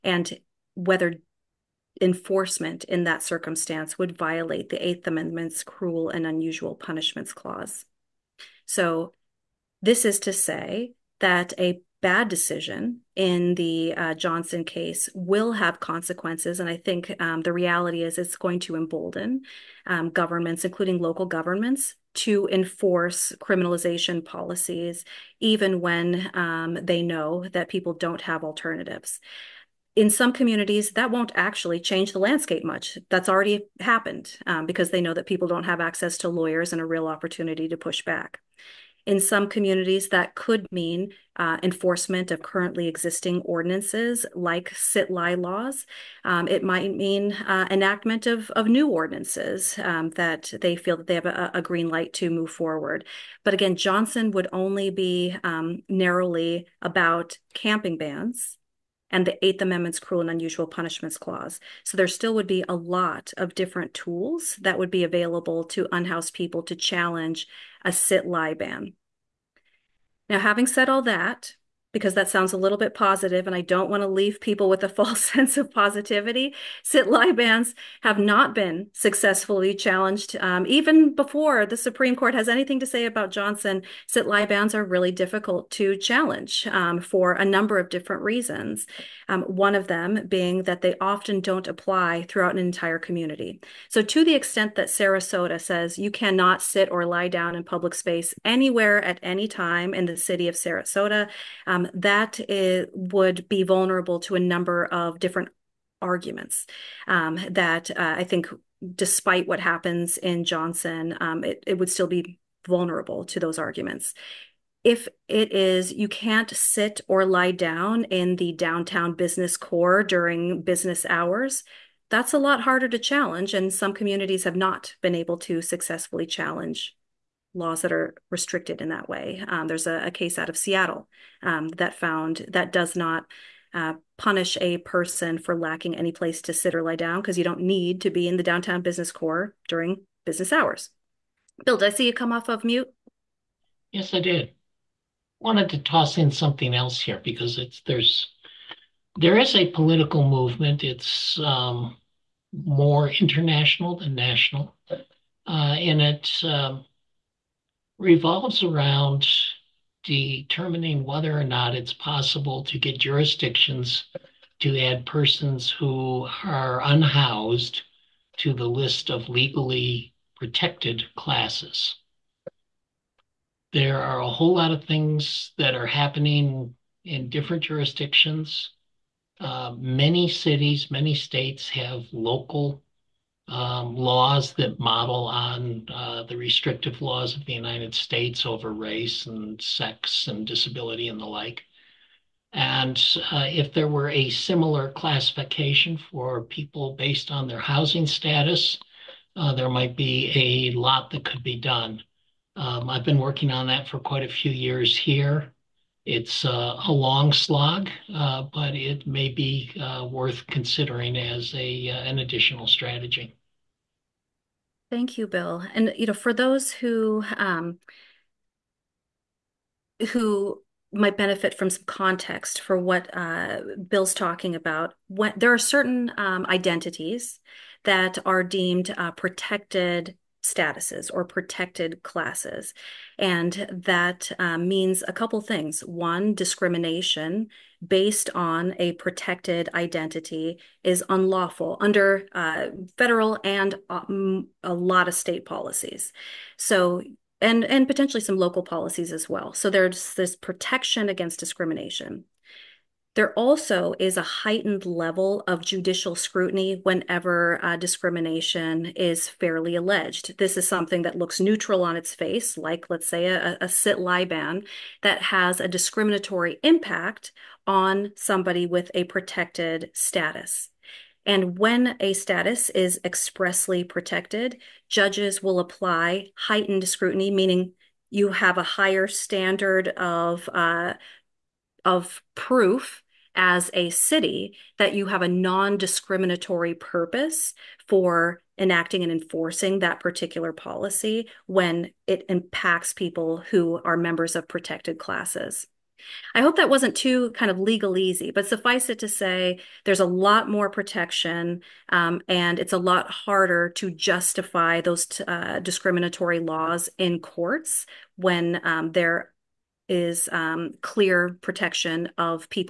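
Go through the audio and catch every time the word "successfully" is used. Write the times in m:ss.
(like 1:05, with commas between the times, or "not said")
1:18, 2:05.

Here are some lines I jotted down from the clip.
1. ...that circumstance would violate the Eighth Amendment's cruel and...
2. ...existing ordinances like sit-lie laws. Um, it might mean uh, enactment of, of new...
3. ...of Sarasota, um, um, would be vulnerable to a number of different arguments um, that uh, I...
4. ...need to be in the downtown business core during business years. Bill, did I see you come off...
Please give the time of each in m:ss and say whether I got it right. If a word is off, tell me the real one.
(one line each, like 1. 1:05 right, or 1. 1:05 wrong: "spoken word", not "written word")
1. 0:03 right
2. 0:42 right
3. 1:40 right
4. 2:17 wrong: "hours", not "years".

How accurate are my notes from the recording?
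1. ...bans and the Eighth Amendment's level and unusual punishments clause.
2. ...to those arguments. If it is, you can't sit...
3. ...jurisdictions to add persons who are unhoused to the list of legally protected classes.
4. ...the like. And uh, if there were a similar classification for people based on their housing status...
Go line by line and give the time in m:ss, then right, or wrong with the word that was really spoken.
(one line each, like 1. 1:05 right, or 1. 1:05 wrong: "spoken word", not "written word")
1. 0:57 wrong: "cruel", not "level"
2. 1:53 right
3. 2:42 right
4. 3:11 right.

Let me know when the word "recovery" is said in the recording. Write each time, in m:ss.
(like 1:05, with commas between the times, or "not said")
not said.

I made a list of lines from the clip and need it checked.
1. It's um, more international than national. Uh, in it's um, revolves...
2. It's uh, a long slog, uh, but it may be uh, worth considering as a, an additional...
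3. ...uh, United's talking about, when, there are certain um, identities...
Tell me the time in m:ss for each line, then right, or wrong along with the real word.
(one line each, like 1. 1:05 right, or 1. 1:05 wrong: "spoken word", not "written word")
1. 2:30 right
2. 3:26 right
3. 3:43 wrong: "Bill", not "United".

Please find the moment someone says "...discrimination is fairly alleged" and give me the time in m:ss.
4:17.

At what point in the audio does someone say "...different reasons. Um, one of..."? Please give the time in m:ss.
1:27.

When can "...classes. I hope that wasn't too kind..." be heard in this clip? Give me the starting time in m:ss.
4:54.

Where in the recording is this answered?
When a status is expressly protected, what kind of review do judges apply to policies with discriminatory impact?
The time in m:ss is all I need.
4:36.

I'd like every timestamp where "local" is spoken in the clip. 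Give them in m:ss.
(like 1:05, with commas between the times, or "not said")
0:20, 3:02, 4:08.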